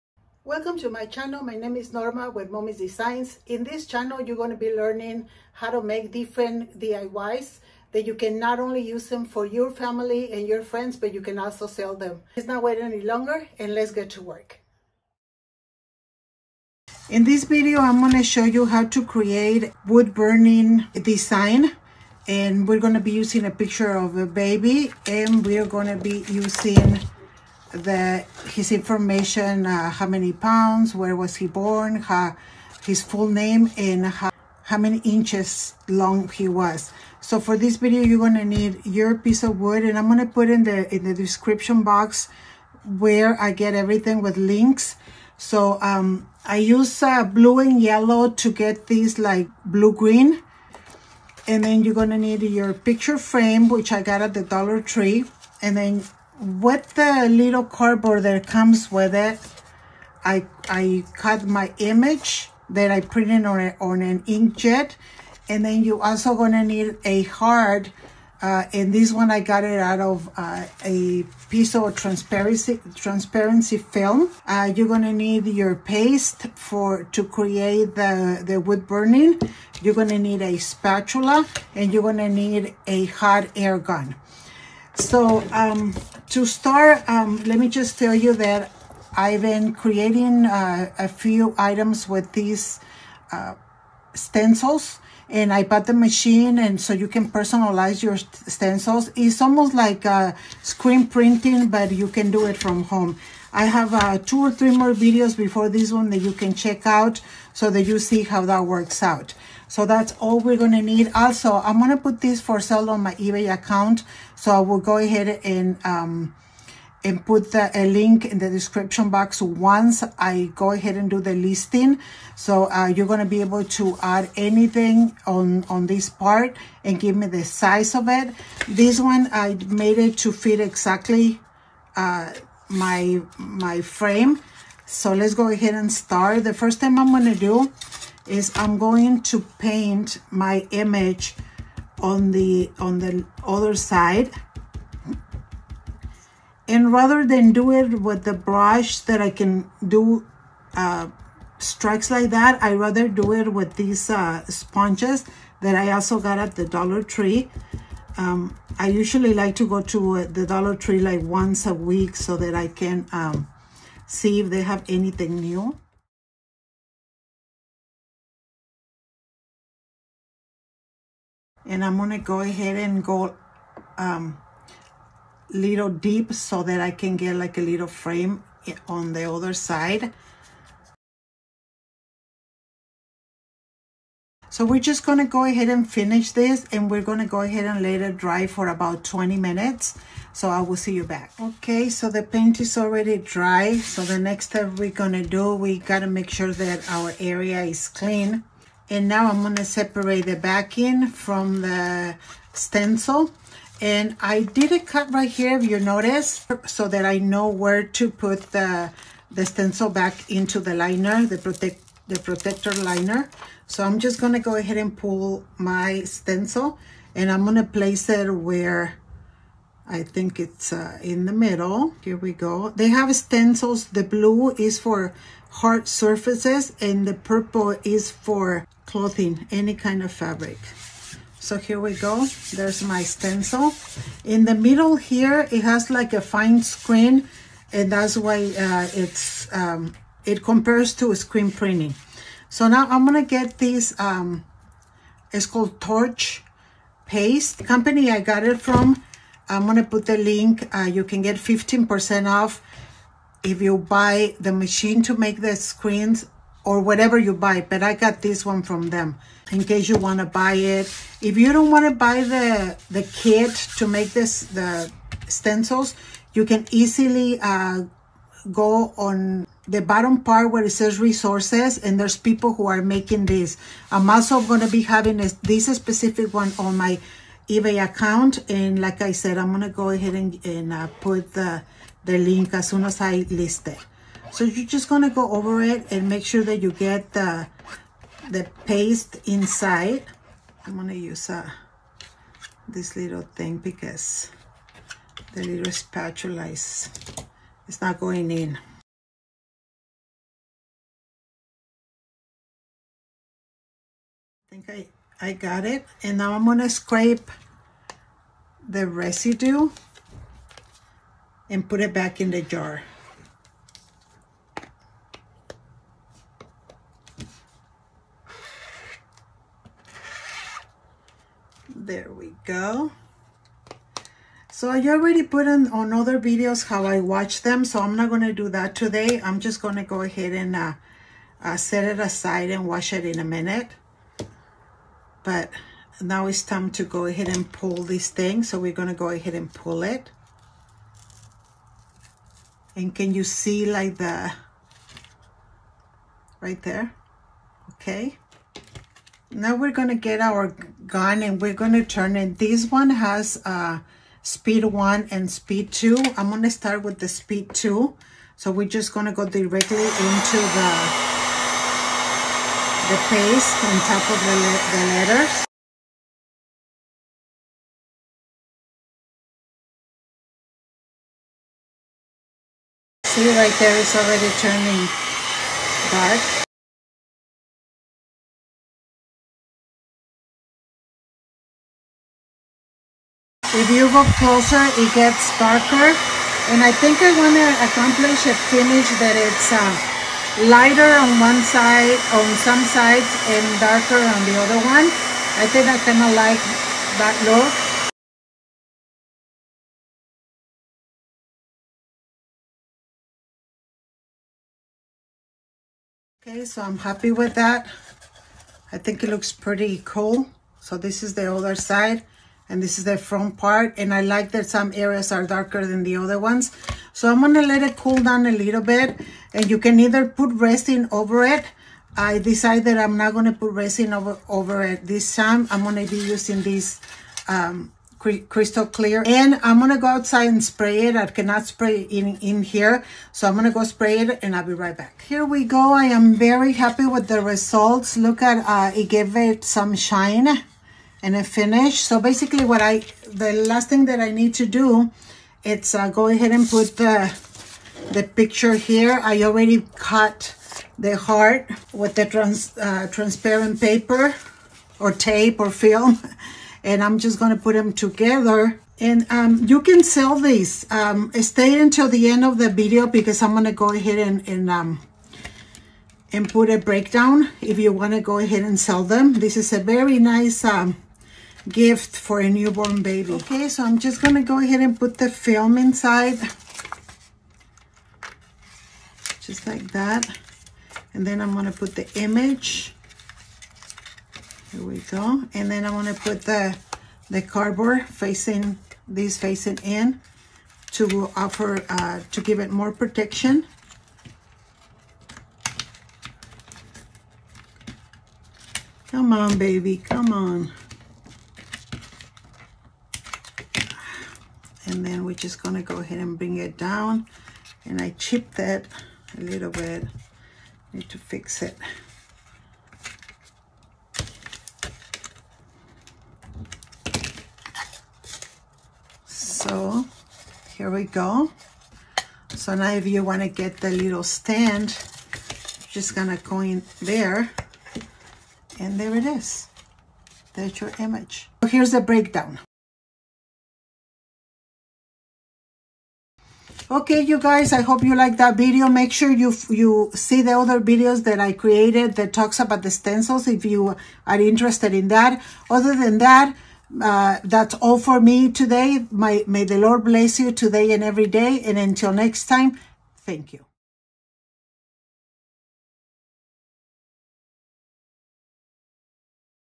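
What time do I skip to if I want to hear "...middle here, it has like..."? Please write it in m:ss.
3:54.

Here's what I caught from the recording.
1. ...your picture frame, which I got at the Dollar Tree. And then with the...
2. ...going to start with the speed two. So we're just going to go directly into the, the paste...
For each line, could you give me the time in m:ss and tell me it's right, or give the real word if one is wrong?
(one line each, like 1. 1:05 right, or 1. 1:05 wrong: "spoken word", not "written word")
1. 0:52 right
2. 5:56 right.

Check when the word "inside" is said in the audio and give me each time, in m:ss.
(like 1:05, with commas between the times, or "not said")
4:49, 7:55.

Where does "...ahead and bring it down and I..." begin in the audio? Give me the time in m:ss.
8:25.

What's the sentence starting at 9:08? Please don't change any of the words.
My, may the Lord bless you today and every day.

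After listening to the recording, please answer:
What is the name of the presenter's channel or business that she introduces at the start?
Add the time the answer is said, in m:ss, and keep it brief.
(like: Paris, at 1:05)
Momis Designs, at 0:02.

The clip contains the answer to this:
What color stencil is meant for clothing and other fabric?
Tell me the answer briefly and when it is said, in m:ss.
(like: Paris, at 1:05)
purple, at 3:47.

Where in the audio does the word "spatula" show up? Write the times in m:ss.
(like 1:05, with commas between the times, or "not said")
1:20, 4:55.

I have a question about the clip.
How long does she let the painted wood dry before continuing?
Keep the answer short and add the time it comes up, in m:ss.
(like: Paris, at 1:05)
20 minutes, at 3:09.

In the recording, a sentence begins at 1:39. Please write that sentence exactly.
It's almost like uh, screen printing, but you can do it from home.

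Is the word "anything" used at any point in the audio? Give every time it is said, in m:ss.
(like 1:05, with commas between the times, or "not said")
2:04, 2:44.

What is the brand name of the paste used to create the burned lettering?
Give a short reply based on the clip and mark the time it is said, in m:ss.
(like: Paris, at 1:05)
Torch Paste, at 4:05.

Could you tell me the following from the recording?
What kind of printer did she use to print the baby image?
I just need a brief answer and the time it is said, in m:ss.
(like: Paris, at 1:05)
inkjet, at 1:04.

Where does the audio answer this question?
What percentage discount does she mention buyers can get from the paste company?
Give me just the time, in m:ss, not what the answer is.
4:11.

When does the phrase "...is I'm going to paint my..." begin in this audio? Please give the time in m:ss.
2:18.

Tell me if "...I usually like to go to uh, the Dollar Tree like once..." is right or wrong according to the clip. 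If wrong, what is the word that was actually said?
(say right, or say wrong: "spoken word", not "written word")
right.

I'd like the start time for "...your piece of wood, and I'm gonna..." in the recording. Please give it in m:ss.
0:38.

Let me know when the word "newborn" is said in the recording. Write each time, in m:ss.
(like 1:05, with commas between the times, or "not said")
7:52.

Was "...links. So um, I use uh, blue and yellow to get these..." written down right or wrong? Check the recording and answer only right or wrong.
right.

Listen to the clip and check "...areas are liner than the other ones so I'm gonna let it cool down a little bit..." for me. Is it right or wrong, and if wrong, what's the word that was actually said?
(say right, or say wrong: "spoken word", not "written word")
wrong: "darker", not "liner".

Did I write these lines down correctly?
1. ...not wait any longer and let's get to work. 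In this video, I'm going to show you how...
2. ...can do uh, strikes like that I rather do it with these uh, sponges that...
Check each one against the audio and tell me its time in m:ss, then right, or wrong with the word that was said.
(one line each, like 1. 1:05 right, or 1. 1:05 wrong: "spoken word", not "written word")
1. 0:12 right
2. 2:29 right.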